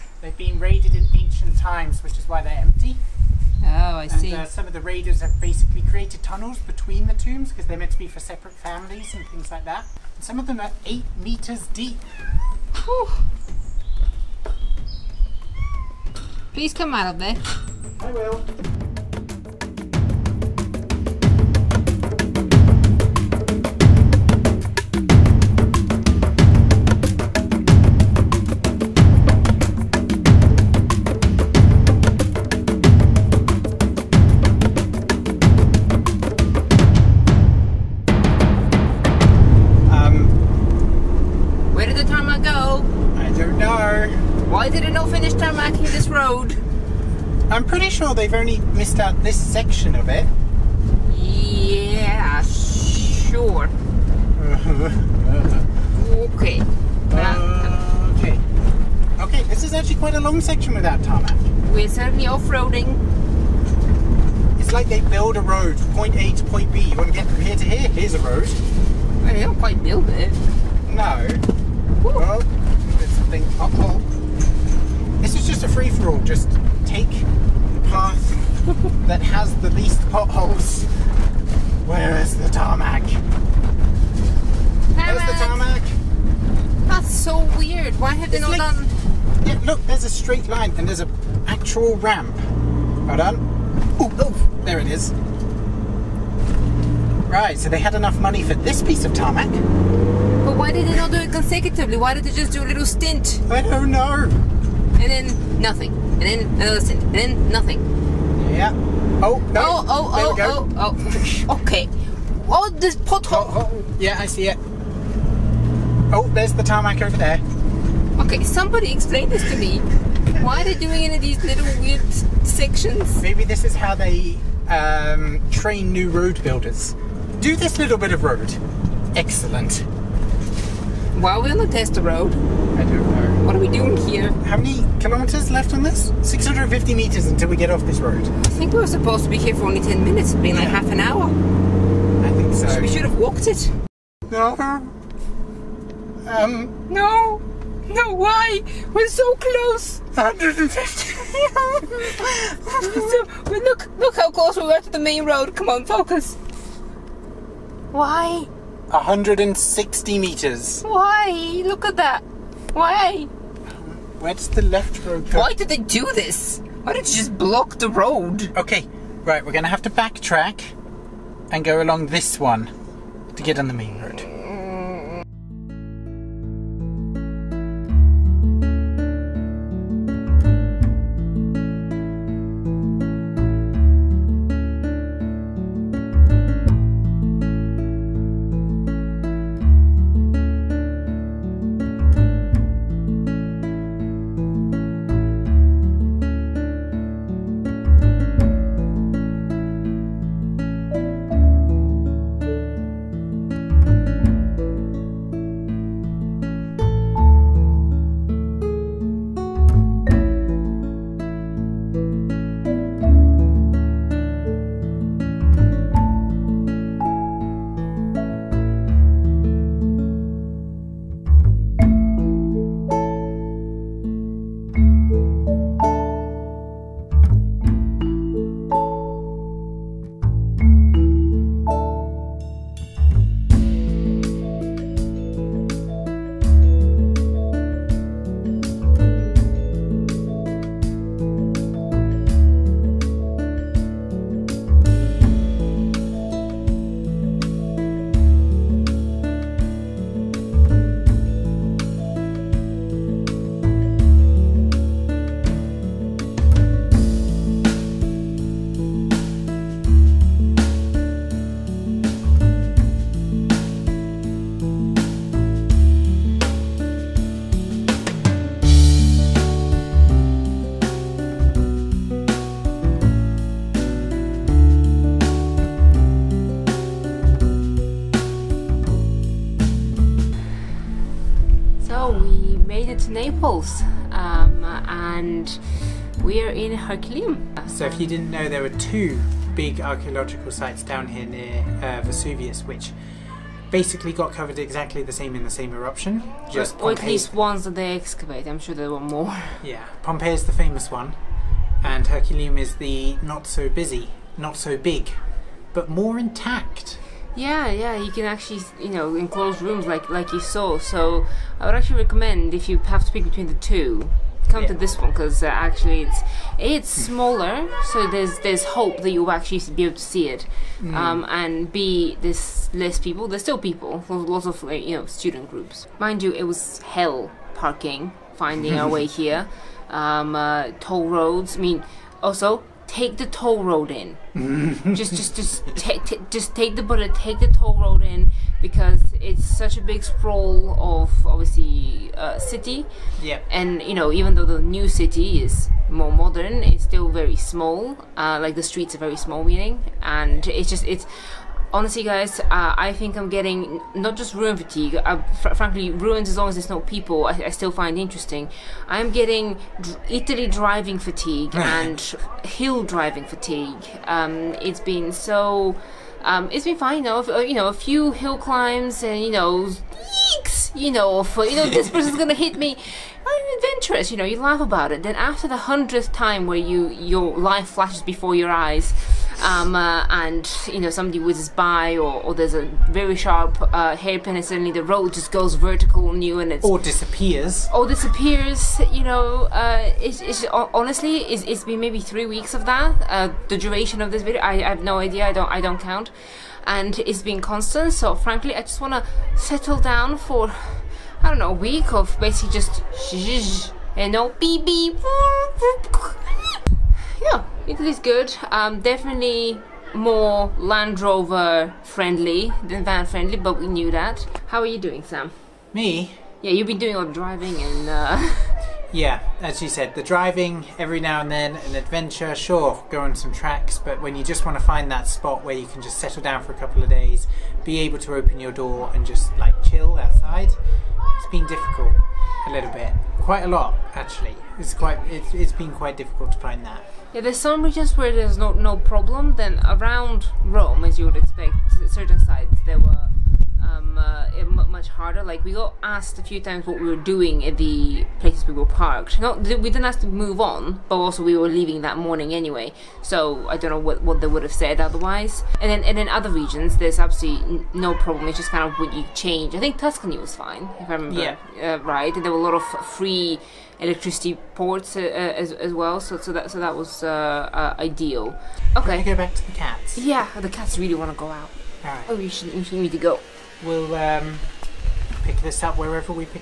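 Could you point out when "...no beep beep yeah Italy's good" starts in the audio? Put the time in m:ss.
6:44.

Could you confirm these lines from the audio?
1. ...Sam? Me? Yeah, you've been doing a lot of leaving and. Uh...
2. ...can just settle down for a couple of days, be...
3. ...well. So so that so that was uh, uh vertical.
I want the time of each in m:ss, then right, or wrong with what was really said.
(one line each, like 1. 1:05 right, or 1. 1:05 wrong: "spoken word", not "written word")
1. 6:55 wrong: "driving", not "leaving"
2. 7:05 right
3. 7:45 wrong: "ideal", not "vertical".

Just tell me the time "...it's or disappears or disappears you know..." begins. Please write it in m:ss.
6:26.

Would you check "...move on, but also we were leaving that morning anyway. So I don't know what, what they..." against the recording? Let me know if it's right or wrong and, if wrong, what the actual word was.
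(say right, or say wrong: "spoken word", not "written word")
right.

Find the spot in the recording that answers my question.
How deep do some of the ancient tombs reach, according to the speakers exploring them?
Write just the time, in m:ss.
0:10.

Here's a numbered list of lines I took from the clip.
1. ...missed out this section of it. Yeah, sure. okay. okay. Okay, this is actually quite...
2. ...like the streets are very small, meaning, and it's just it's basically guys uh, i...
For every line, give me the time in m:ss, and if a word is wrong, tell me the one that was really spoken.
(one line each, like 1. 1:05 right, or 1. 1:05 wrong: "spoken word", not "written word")
1. 0:48 right
2. 5:48 wrong: "honestly", not "basically".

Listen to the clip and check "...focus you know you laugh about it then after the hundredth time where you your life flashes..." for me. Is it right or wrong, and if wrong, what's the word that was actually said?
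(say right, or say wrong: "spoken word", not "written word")
wrong: "adventurous", not "focus".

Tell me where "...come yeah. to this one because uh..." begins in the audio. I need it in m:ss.
5:14.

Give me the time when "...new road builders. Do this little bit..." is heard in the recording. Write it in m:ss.
2:05.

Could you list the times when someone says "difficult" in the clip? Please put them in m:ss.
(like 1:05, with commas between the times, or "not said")
7:11, 7:15.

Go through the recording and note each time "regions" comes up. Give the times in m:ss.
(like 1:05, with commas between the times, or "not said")
7:17, 7:36.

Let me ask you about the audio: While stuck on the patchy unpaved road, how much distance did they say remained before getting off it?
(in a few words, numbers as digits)
650 meters.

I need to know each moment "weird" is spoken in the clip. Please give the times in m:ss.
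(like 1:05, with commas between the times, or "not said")
1:27, 2:01.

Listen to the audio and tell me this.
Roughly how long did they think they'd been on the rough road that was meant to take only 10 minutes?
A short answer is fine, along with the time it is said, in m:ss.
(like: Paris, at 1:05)
half an hour, at 2:20.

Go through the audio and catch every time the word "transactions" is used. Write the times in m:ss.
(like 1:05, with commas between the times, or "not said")
not said.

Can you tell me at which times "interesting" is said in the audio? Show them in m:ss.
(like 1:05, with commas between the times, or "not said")
5:57.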